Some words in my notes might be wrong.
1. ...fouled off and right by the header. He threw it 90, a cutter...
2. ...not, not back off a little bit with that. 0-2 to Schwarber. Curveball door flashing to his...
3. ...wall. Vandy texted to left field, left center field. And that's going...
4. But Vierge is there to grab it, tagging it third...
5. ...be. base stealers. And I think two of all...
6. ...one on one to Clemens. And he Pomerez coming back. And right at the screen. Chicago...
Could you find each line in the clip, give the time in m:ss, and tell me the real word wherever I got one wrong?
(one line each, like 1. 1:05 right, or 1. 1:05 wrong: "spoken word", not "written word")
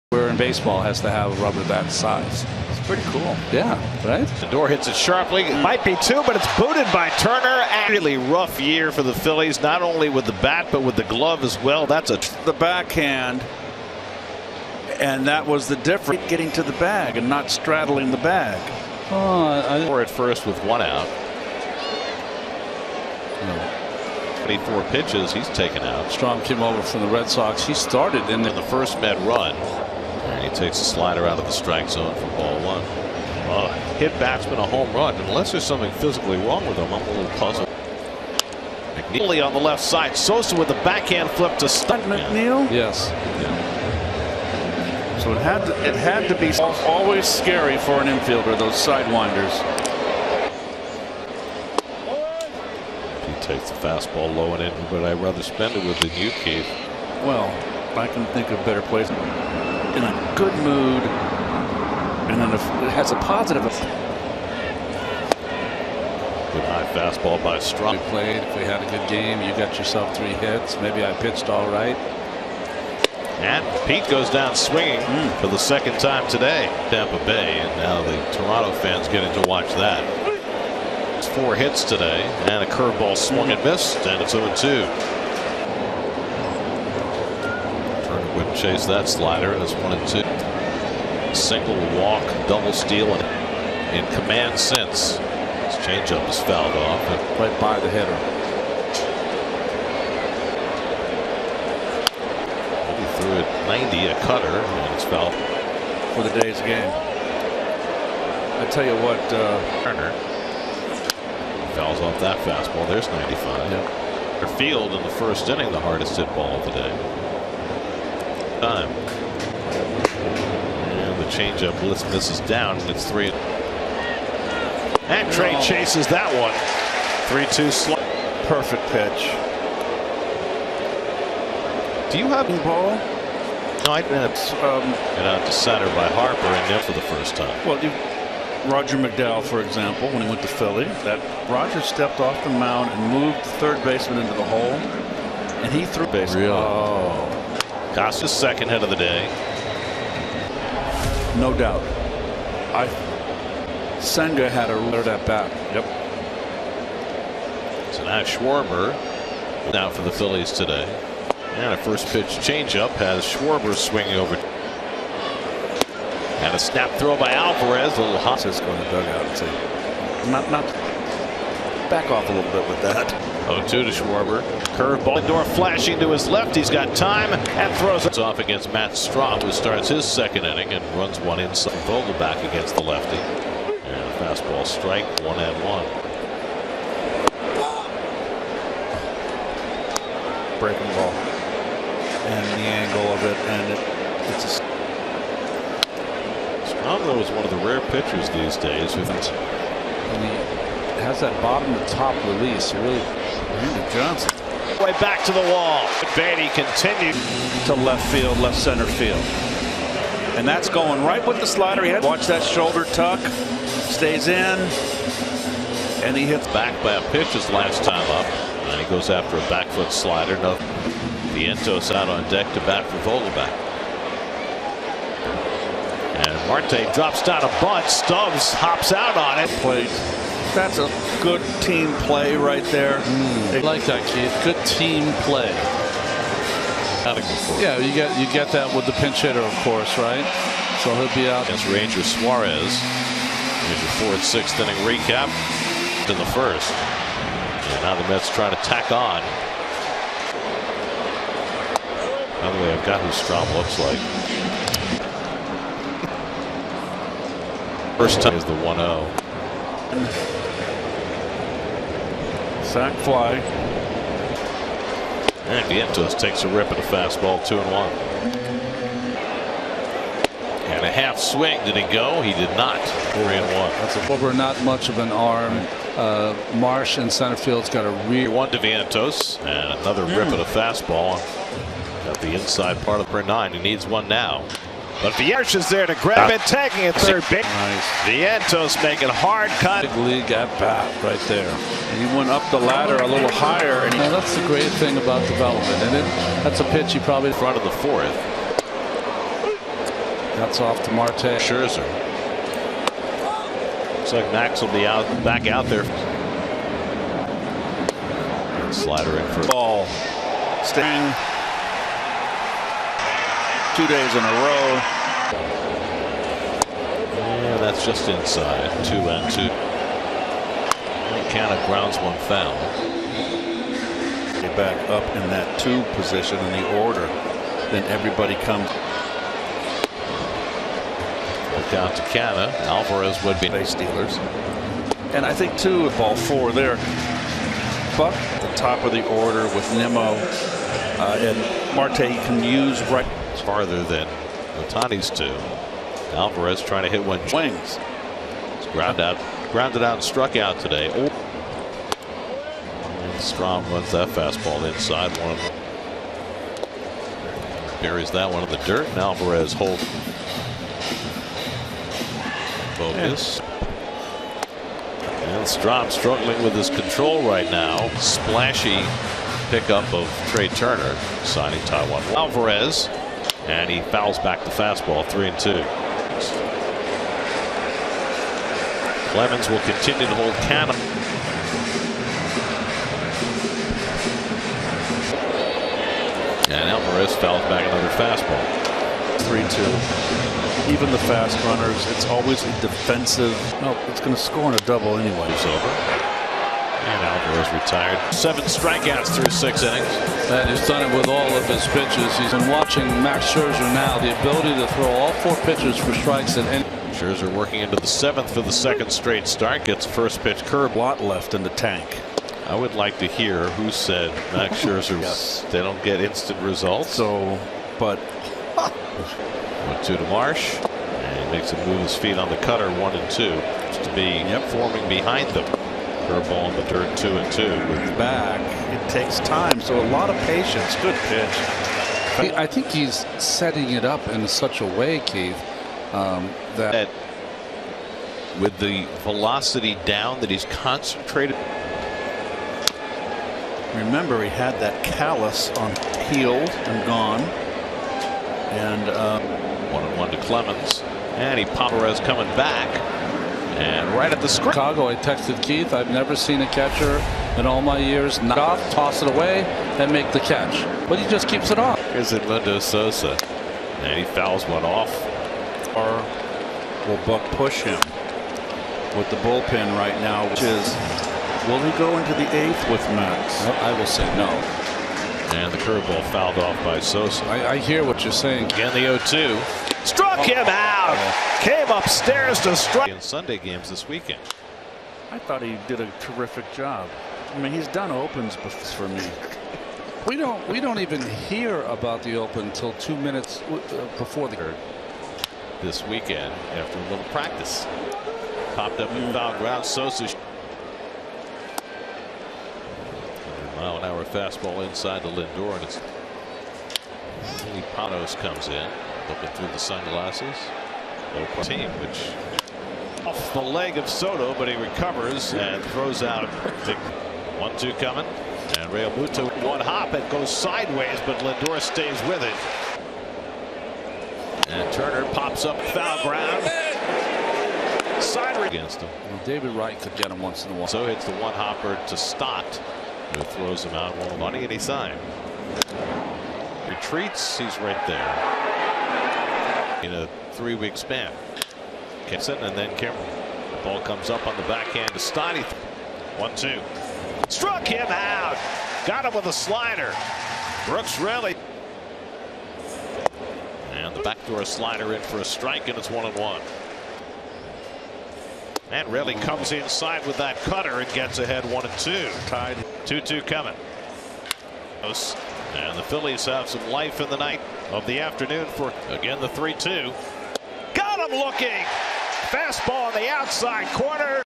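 1. 1:36 right
2. 2:50 right
3. 3:25 wrong: "continued", not "texted"
4. 4:45 right
5. 5:33 right
6. 7:29 right.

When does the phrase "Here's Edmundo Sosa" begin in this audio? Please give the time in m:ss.
7:41.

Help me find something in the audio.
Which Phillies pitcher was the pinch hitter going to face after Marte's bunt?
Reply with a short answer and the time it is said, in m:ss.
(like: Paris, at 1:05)
Ranger Suarez, at 4:01.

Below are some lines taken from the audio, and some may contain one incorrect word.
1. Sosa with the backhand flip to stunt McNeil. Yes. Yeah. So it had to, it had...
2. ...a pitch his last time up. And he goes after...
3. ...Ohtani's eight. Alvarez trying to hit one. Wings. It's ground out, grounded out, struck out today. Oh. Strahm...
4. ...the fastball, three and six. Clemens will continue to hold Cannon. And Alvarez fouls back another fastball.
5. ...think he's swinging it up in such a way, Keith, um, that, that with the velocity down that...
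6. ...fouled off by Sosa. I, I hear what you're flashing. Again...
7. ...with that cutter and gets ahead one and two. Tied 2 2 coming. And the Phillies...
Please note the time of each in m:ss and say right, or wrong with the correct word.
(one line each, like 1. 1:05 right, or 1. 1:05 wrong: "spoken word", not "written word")
1. 0:40 right
2. 3:36 right
3. 5:44 wrong: "two", not "eight"
4. 6:14 wrong: "two", not "six"
5. 7:12 wrong: "setting", not "swinging"
6. 7:56 wrong: "saying", not "flashing"
7. 9:20 right.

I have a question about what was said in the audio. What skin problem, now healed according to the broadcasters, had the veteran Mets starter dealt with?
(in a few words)
callus.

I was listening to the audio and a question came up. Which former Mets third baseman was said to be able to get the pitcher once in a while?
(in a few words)
David Wright.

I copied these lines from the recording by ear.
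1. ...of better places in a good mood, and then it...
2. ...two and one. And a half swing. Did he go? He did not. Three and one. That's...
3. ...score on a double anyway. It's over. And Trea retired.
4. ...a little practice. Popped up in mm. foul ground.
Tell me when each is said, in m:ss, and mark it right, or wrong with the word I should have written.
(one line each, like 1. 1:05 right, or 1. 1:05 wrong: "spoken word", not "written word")
1. 0:58 right
2. 4:27 right
3. 6:34 wrong: "Alvarez", not "Trea"
4. 8:16 right.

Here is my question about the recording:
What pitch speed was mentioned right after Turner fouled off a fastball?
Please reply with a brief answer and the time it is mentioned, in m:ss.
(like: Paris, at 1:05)
95, at 1:53.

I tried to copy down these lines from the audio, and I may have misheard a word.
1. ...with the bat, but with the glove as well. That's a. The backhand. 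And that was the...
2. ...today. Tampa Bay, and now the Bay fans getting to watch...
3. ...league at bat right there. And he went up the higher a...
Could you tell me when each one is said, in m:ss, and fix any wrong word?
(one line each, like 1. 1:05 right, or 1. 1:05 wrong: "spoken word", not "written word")
1. 0:10 right
2. 1:16 wrong: "Toronto", not "Bay"
3. 4:49 wrong: "ladder", not "higher".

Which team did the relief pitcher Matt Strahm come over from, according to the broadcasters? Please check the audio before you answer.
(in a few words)
Red Sox.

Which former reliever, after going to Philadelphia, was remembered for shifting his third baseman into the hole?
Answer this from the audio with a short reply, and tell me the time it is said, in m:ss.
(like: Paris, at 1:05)
Roger McDowell, at 2:18.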